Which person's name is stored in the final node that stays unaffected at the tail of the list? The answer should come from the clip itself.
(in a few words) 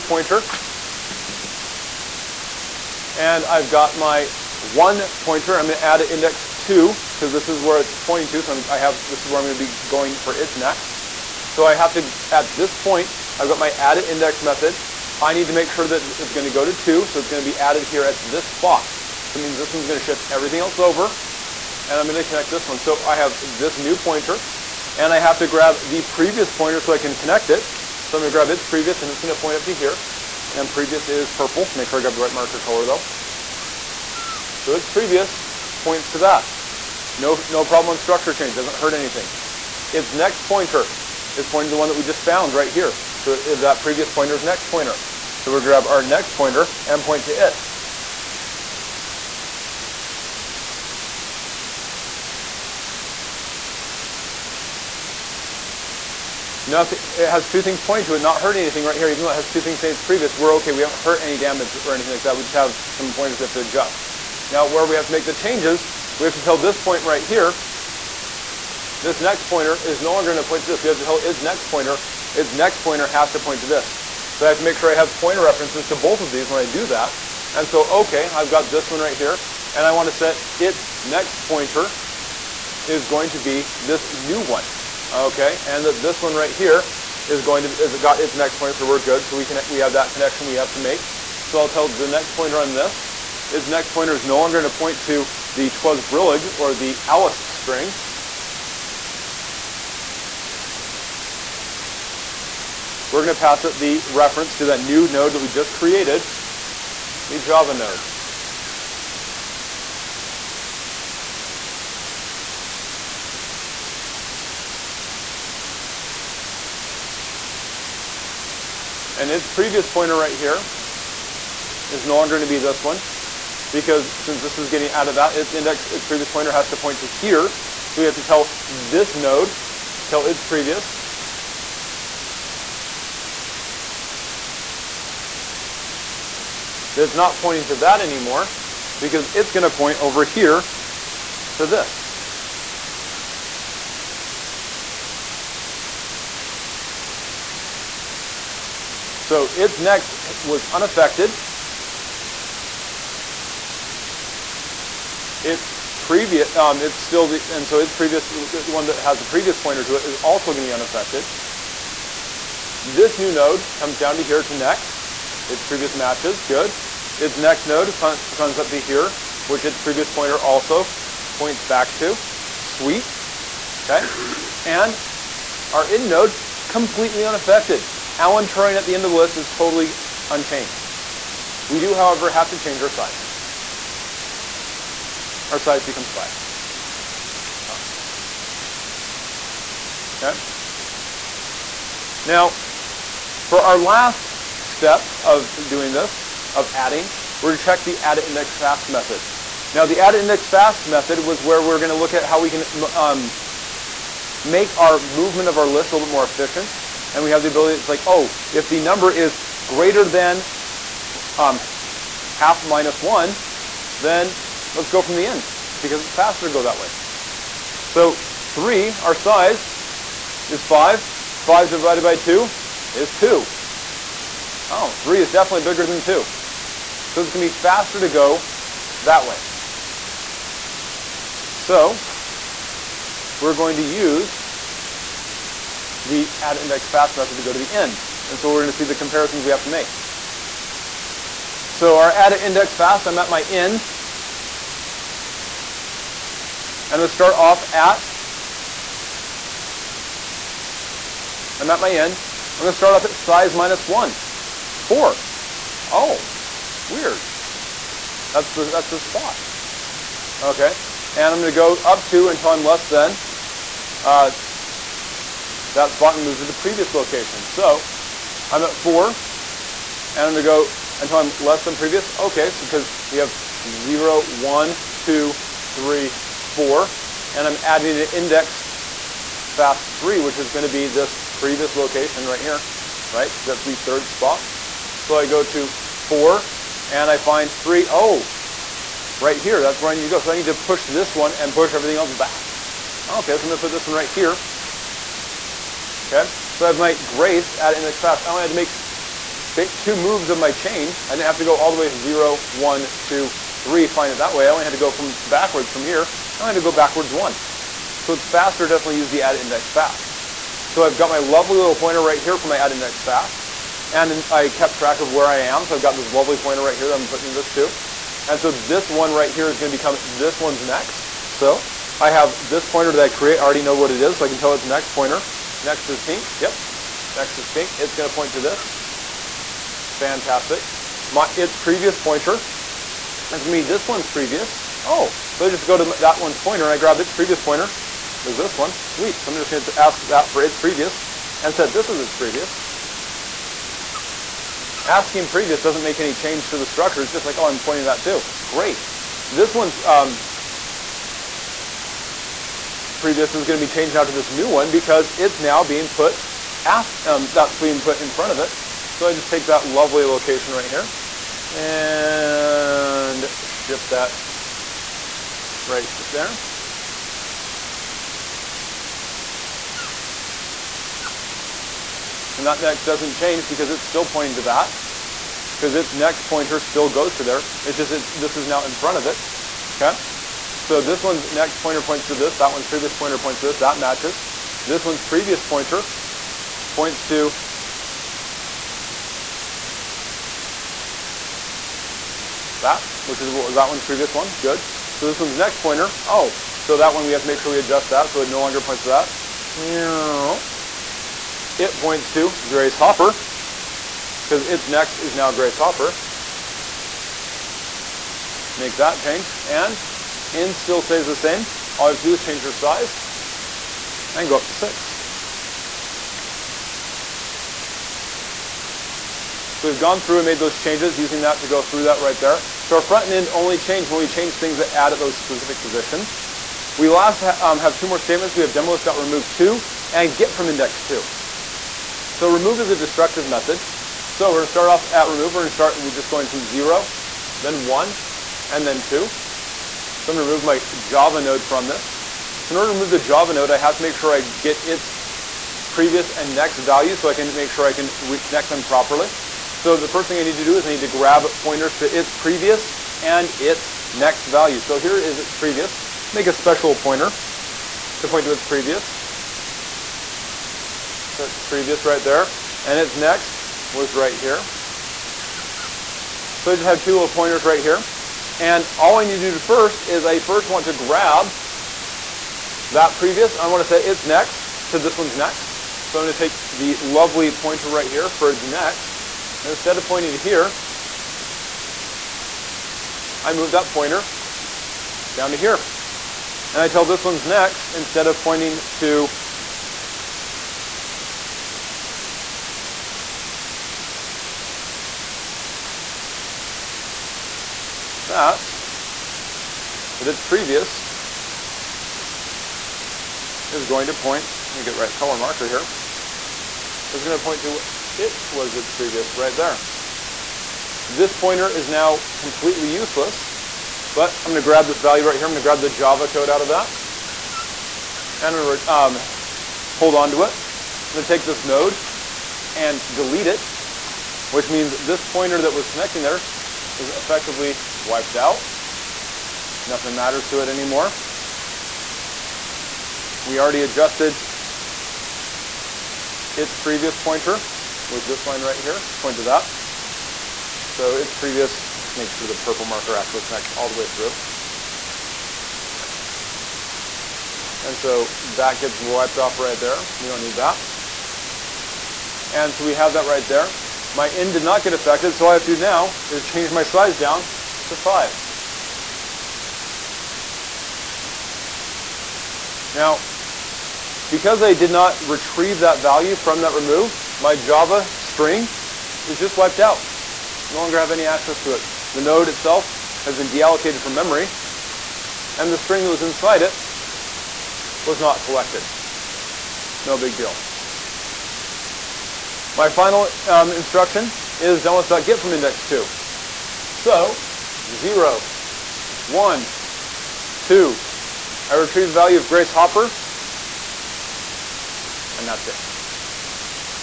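Alan Turing.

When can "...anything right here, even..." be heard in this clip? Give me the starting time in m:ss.
0:58.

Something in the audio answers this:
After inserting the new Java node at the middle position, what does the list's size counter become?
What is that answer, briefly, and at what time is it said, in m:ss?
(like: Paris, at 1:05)
5, at 3:05.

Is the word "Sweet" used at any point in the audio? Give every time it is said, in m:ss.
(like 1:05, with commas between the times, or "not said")
2:52, 5:38.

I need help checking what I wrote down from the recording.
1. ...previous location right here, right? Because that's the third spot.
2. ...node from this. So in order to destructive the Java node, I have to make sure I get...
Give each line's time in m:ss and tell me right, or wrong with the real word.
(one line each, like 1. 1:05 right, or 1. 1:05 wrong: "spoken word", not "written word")
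1. 4:41 right
2. 7:21 wrong: "remove", not "destructive".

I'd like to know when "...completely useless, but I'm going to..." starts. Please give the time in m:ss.
8:32.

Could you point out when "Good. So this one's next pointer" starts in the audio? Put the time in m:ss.
6:34.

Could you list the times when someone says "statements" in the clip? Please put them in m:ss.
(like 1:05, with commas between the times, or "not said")
7:07.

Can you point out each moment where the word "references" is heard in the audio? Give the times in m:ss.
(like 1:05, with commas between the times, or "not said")
1:15, 1:44.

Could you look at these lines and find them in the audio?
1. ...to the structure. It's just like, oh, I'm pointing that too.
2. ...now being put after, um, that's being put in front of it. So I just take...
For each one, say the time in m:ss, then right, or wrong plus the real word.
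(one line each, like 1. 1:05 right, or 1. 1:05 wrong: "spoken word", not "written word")
1. 5:46 right
2. 5:55 right.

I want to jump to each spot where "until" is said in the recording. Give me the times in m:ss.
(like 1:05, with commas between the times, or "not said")
4:22, 4:30.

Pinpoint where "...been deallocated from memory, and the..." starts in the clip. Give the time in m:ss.
9:33.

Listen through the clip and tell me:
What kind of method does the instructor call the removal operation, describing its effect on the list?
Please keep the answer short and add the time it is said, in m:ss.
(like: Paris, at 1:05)
Destructive, at 7:12.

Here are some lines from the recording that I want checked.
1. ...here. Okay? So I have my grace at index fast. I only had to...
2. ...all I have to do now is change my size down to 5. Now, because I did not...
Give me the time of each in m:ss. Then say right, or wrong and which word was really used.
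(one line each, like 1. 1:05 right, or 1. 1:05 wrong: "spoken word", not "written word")
1. 4:54 right
2. 9:15 right.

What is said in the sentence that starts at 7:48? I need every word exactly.
And all I need to do first is I first want to grab that previous.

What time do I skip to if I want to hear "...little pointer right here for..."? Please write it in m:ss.
5:11.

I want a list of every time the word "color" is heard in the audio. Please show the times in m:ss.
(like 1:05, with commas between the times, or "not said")
0:32, 8:24.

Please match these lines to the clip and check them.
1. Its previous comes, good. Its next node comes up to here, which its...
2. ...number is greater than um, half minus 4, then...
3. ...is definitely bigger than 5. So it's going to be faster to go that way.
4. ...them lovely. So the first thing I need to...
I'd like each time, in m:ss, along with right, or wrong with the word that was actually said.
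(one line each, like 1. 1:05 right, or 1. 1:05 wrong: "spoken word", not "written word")
1. 2:45 wrong: "matches", not "comes"
2. 3:28 wrong: "1", not "4"
3. 3:45 wrong: "2", not "5"
4. 7:28 wrong: "properly", not "lovely".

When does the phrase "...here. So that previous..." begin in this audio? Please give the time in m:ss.
0:42.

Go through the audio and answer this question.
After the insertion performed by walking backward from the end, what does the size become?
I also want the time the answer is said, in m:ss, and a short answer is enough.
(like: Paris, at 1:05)
6, at 6:54.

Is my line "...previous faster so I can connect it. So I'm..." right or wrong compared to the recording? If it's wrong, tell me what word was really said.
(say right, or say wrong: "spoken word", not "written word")
wrong: "pointer", not "faster".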